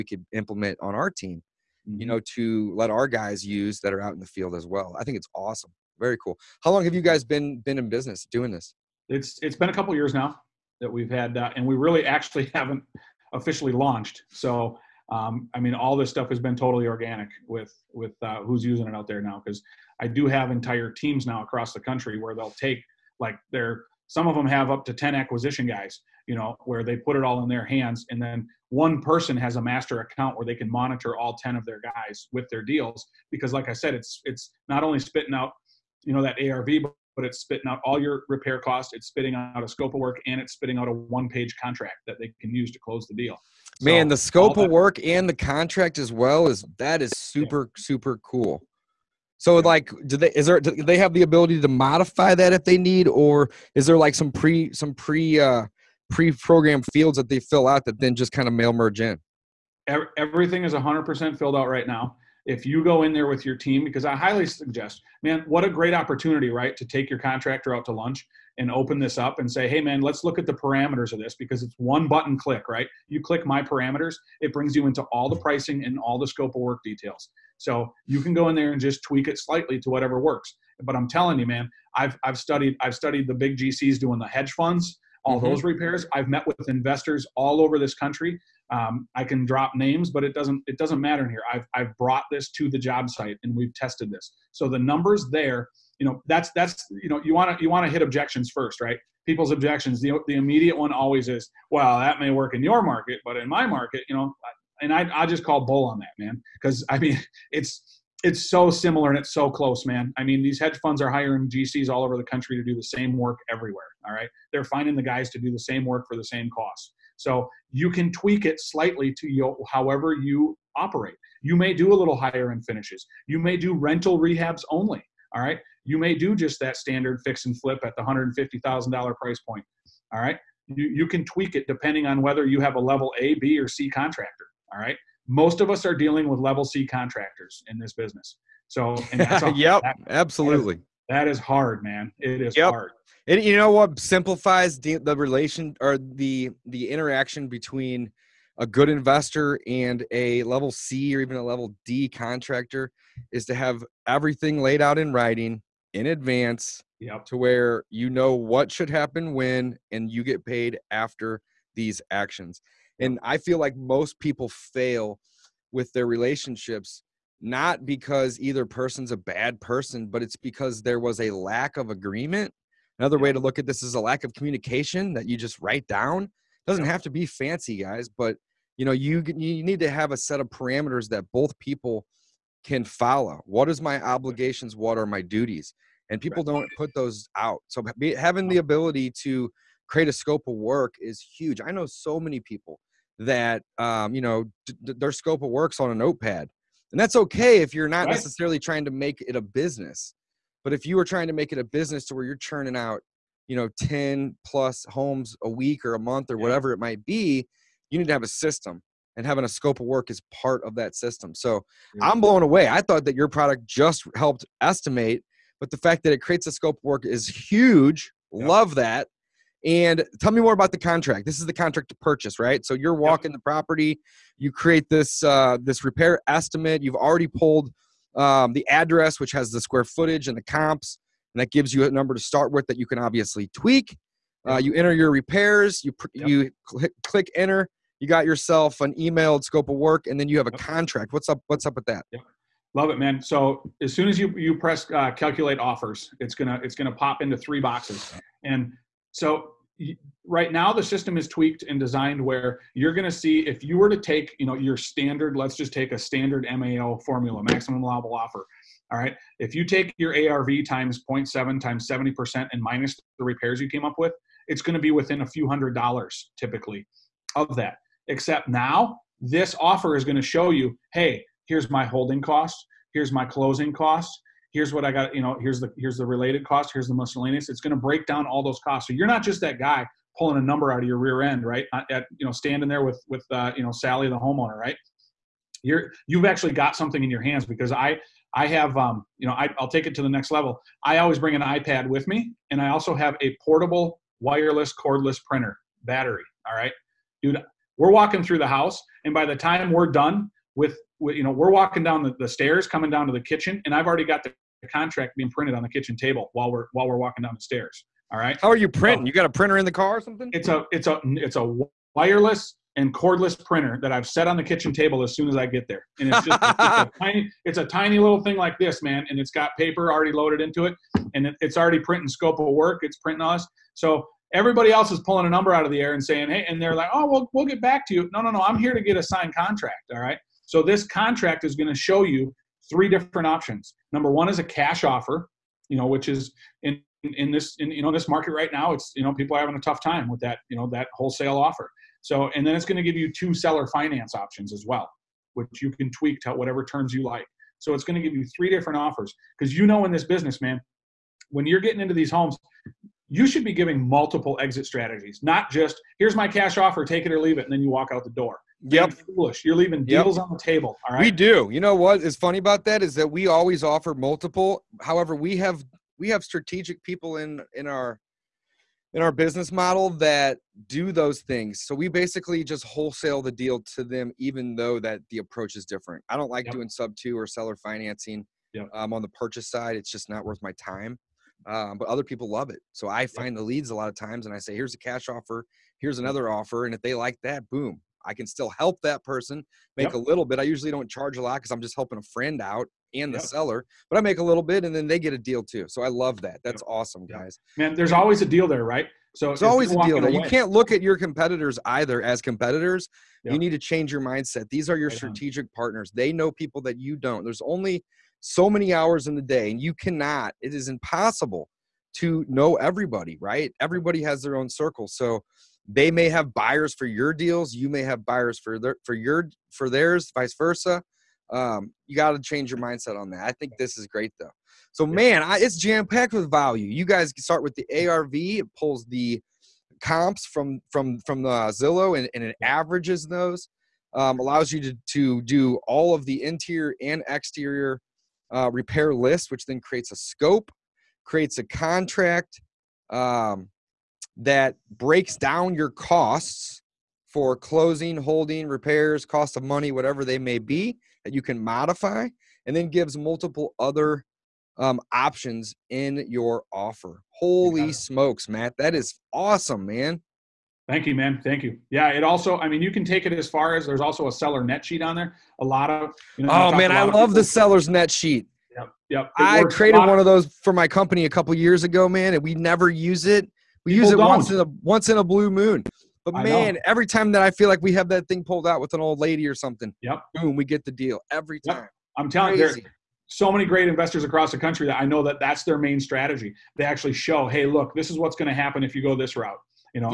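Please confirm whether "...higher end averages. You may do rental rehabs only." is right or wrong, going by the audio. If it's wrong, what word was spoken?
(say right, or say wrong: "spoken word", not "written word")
wrong: "finishes", not "averages".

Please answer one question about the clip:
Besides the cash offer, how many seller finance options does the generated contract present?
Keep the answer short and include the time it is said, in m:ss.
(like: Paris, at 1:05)
2, at 5:43.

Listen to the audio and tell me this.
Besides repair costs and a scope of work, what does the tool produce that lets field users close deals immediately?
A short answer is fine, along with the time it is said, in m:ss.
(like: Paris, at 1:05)
one page contract, at 0:40.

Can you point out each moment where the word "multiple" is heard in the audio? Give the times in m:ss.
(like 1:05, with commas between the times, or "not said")
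5:53, 6:03, 7:32.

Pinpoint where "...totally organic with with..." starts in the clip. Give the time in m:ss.
0:16.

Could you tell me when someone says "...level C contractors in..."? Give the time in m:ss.
2:16.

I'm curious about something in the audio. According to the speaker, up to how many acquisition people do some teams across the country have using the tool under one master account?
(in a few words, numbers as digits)
10.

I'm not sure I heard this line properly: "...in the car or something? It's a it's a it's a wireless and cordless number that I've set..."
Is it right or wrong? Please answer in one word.
wrong.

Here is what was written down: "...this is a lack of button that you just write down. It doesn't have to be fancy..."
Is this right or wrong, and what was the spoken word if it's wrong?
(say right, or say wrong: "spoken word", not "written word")
wrong: "communication", not "button".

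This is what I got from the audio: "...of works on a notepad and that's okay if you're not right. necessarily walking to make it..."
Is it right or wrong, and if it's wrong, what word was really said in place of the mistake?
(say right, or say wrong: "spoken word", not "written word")
wrong: "trying", not "walking".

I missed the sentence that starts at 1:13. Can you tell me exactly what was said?
You click my parameters, it brings you into all the pricing and all the scope of work details.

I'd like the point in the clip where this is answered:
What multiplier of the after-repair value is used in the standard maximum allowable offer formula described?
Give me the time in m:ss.
4:21.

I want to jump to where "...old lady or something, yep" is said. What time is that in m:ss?
7:58.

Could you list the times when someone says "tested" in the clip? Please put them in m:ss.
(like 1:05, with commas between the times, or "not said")
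1:33.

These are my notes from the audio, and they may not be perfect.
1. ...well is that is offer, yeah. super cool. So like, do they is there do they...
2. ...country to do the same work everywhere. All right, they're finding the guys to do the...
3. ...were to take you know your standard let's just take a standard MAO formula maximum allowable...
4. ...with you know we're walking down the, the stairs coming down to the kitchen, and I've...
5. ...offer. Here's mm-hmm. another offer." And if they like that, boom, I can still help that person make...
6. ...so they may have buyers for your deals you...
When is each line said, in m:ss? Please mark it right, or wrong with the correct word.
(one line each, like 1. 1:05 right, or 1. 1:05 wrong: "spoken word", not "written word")
1. 0:46 wrong: "super", not "offer"
2. 1:52 right
3. 4:13 right
4. 5:00 right
5. 6:25 right
6. 6:54 right.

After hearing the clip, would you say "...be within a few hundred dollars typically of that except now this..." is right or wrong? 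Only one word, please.
right.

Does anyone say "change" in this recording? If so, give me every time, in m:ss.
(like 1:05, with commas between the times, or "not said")
6:43, 7:02.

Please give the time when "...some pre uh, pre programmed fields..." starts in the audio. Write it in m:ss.
0:54.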